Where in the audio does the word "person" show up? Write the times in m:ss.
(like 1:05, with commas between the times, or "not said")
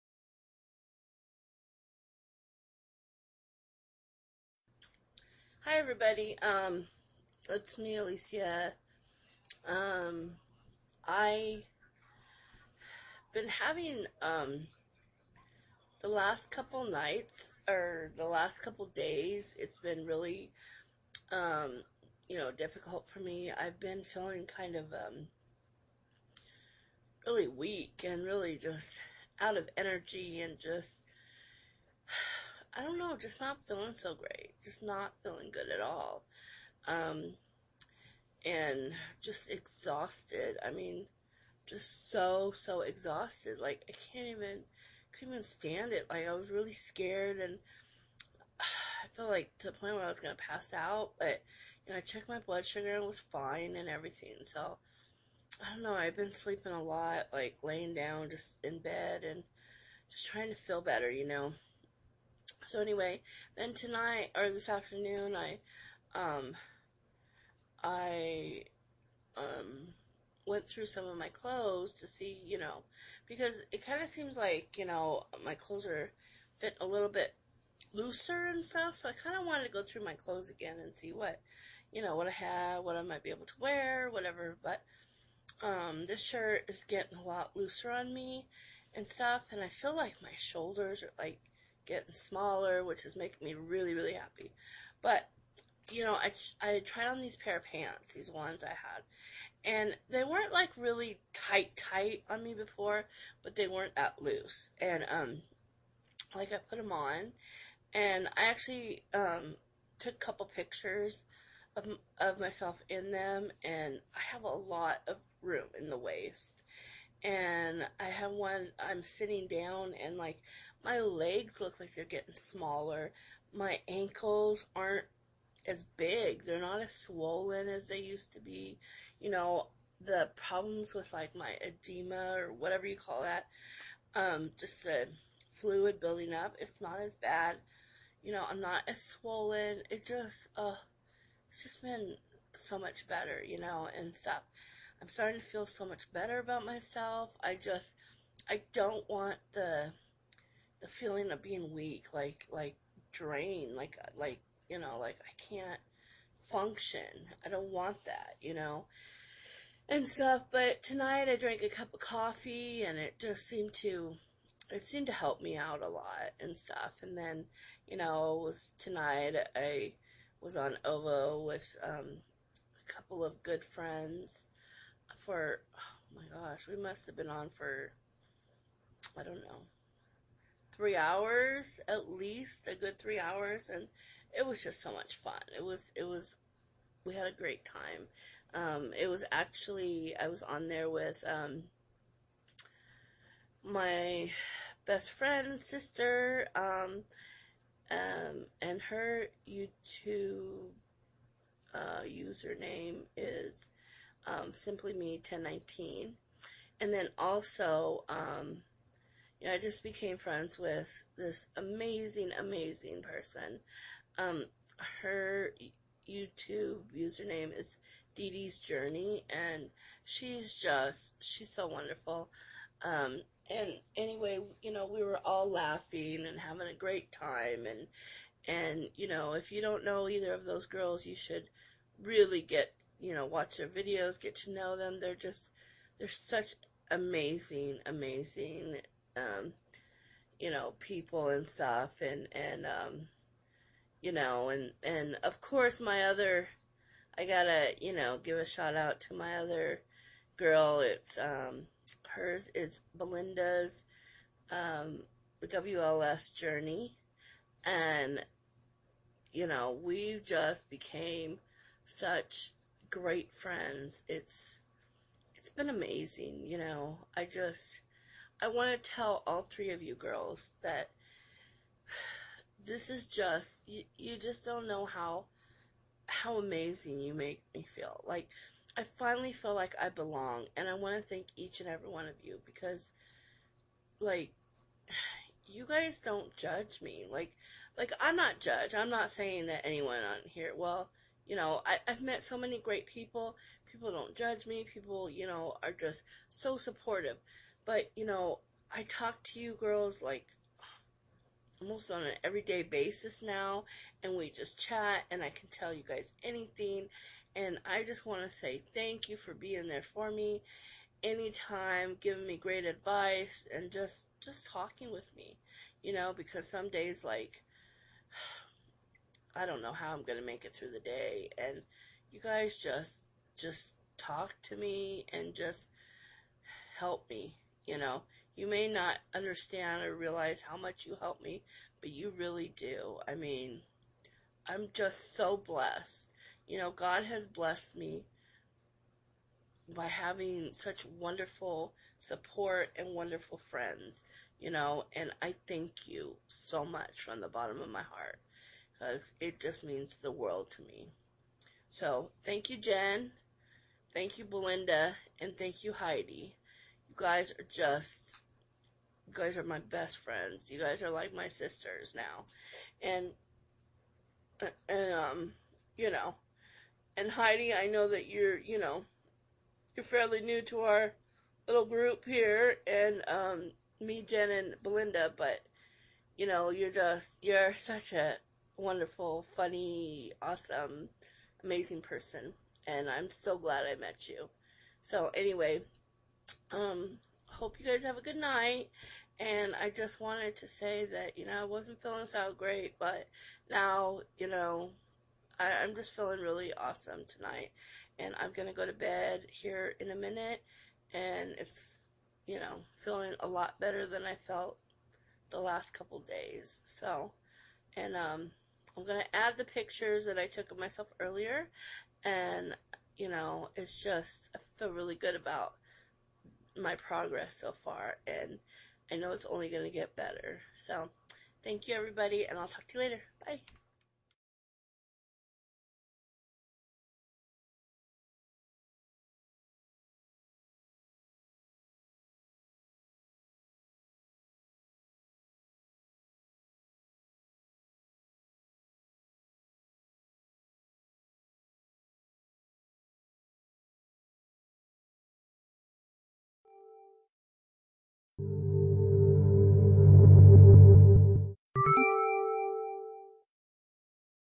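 3:33, 6:21.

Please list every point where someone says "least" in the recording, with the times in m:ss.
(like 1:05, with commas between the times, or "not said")
3:02.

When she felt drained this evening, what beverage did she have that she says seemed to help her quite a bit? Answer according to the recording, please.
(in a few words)
Coffee.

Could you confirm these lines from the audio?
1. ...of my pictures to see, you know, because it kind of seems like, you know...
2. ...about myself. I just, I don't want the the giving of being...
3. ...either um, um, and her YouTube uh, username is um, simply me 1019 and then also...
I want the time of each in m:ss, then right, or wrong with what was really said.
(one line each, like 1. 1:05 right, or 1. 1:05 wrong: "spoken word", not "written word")
1. 1:11 wrong: "clothes", not "pictures"
2. 2:26 wrong: "feeling", not "giving"
3. 3:15 wrong: "sister", not "either".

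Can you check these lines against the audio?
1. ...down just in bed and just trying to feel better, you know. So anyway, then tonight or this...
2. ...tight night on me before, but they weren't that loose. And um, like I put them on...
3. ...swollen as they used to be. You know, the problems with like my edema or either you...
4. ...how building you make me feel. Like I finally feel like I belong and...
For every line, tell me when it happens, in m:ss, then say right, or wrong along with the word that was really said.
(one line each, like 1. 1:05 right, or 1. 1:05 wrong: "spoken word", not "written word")
1. 0:57 right
2. 1:41 wrong: "tight", not "night"
3. 2:06 wrong: "whatever", not "either"
4. 4:36 wrong: "amazing", not "building".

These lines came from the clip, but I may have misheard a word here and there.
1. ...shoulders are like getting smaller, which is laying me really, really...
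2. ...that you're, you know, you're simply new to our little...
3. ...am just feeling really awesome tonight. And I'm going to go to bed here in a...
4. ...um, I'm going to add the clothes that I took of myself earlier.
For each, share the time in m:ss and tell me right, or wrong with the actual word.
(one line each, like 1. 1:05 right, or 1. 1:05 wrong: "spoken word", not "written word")
1. 1:30 wrong: "making", not "laying"
2. 6:07 wrong: "fairly", not "simply"
3. 6:35 right
4. 6:47 wrong: "pictures", not "clothes".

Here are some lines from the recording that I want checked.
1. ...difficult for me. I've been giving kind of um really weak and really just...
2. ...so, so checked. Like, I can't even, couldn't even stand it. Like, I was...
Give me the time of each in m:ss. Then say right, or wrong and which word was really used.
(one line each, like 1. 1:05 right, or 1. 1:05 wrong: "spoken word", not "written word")
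1. 0:22 wrong: "feeling", not "giving"
2. 0:42 wrong: "exhausted", not "checked".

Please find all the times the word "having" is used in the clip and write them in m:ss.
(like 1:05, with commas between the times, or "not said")
0:13, 3:46, 5:39.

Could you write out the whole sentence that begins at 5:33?
I mean, I'm just so blessed.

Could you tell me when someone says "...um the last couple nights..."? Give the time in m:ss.
0:14.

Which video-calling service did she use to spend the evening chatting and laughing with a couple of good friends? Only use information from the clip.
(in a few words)
ooVoo.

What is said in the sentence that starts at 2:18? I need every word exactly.
You know, I'm not as swollen.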